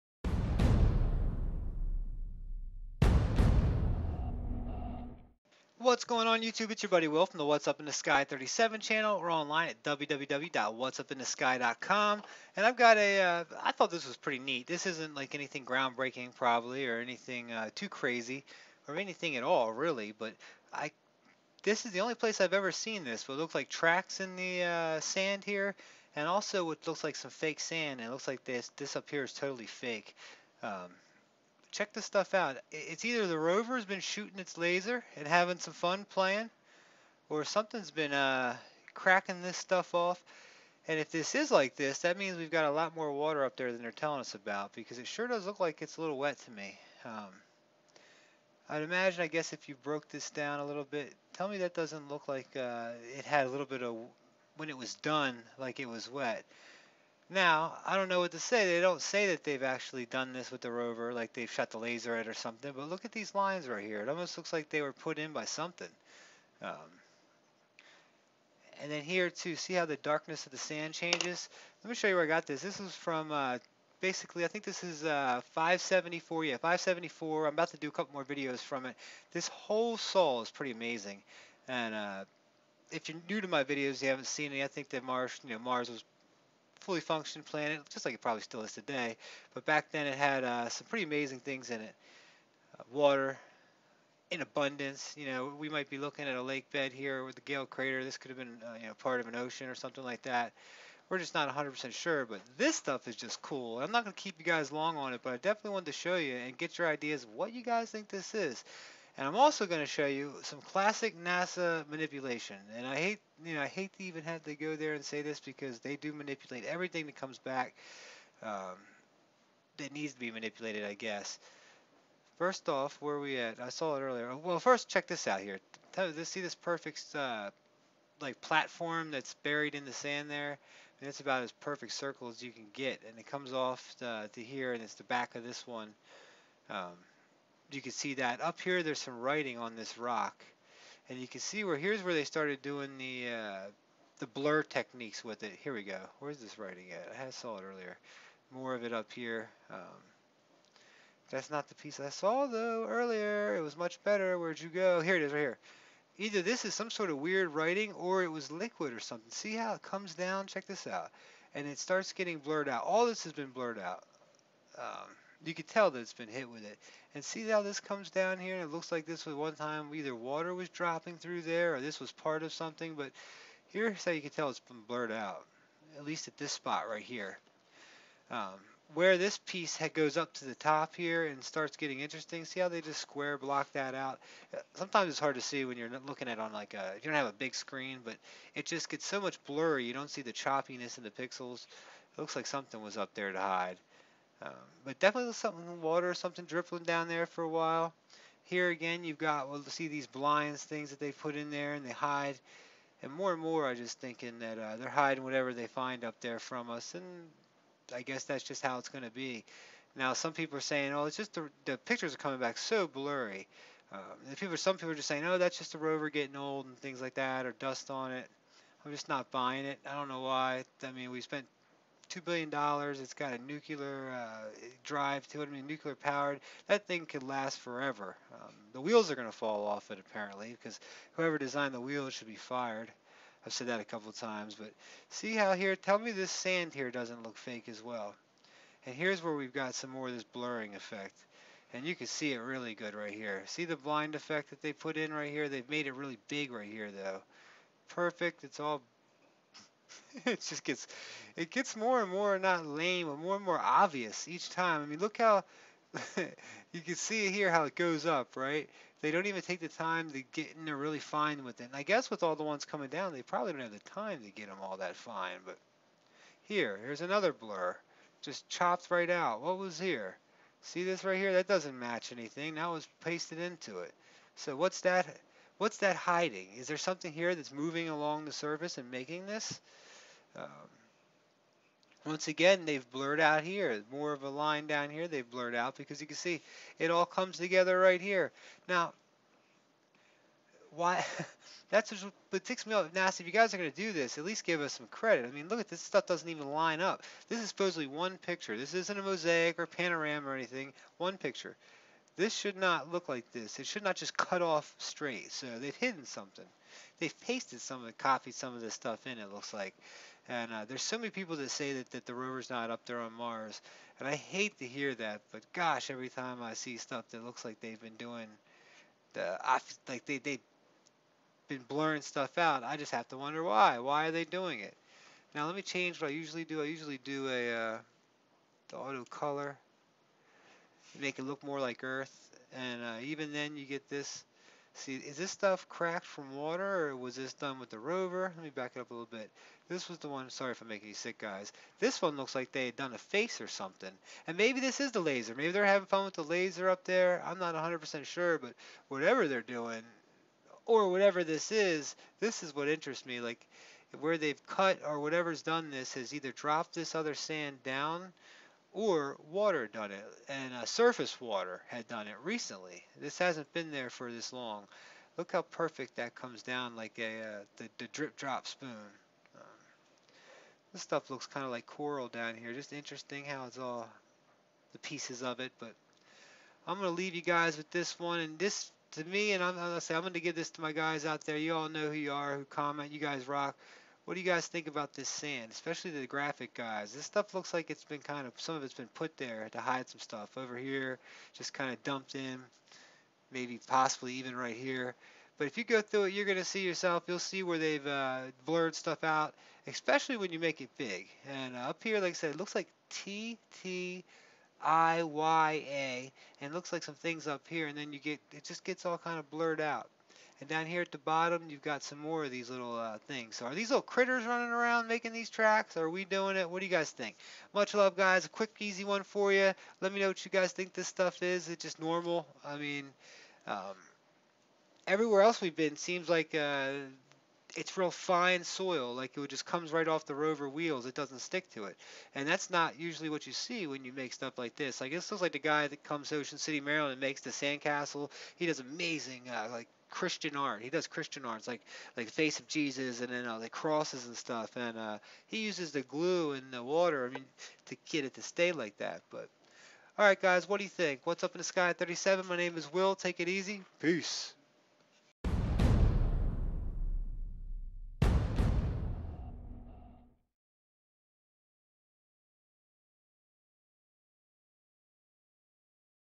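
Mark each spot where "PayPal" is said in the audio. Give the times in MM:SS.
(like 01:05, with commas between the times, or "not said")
not said.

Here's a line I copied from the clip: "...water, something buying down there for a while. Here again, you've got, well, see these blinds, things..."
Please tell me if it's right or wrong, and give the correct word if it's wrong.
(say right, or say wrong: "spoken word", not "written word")
wrong: "dripping", not "buying".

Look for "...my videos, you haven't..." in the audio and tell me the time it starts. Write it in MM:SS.
01:23.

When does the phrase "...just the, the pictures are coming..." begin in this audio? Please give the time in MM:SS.
03:31.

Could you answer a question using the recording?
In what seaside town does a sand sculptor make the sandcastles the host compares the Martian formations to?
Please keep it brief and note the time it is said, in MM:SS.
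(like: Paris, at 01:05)
Ocean City, Maryland, at 07:16.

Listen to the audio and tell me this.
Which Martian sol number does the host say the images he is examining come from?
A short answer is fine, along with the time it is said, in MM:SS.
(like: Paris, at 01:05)
574, at 01:15.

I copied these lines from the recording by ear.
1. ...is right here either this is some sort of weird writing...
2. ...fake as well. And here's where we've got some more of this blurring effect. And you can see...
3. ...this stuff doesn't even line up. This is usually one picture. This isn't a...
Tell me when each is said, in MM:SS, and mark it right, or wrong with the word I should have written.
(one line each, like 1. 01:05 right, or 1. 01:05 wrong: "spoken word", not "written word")
1. 02:35 right
2. 03:57 right
3. 04:55 wrong: "supposedly", not "usually".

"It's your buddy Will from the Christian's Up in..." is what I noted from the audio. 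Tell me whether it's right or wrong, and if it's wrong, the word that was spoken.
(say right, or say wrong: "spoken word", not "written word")
wrong: "What", not "Christian".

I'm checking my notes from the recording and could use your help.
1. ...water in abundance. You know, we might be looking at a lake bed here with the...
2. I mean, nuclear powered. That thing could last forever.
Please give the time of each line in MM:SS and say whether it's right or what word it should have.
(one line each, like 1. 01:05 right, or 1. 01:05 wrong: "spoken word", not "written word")
1. 01:32 right
2. 03:45 right.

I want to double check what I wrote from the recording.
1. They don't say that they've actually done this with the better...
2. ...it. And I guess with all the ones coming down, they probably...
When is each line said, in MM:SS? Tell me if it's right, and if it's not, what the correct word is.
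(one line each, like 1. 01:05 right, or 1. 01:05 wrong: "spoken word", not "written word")
1. 00:58 wrong: "rover", not "better"
2. 04:21 right.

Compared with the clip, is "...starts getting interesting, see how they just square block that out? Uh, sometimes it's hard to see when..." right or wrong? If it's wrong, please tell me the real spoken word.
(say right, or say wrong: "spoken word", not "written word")
right.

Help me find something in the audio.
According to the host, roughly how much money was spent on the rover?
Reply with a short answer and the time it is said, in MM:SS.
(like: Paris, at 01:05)
two billion dollars, at 03:42.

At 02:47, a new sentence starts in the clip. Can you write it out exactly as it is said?
And see how this comes down here?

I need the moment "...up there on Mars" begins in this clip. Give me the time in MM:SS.
05:12.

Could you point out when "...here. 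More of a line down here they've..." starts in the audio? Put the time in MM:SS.
04:43.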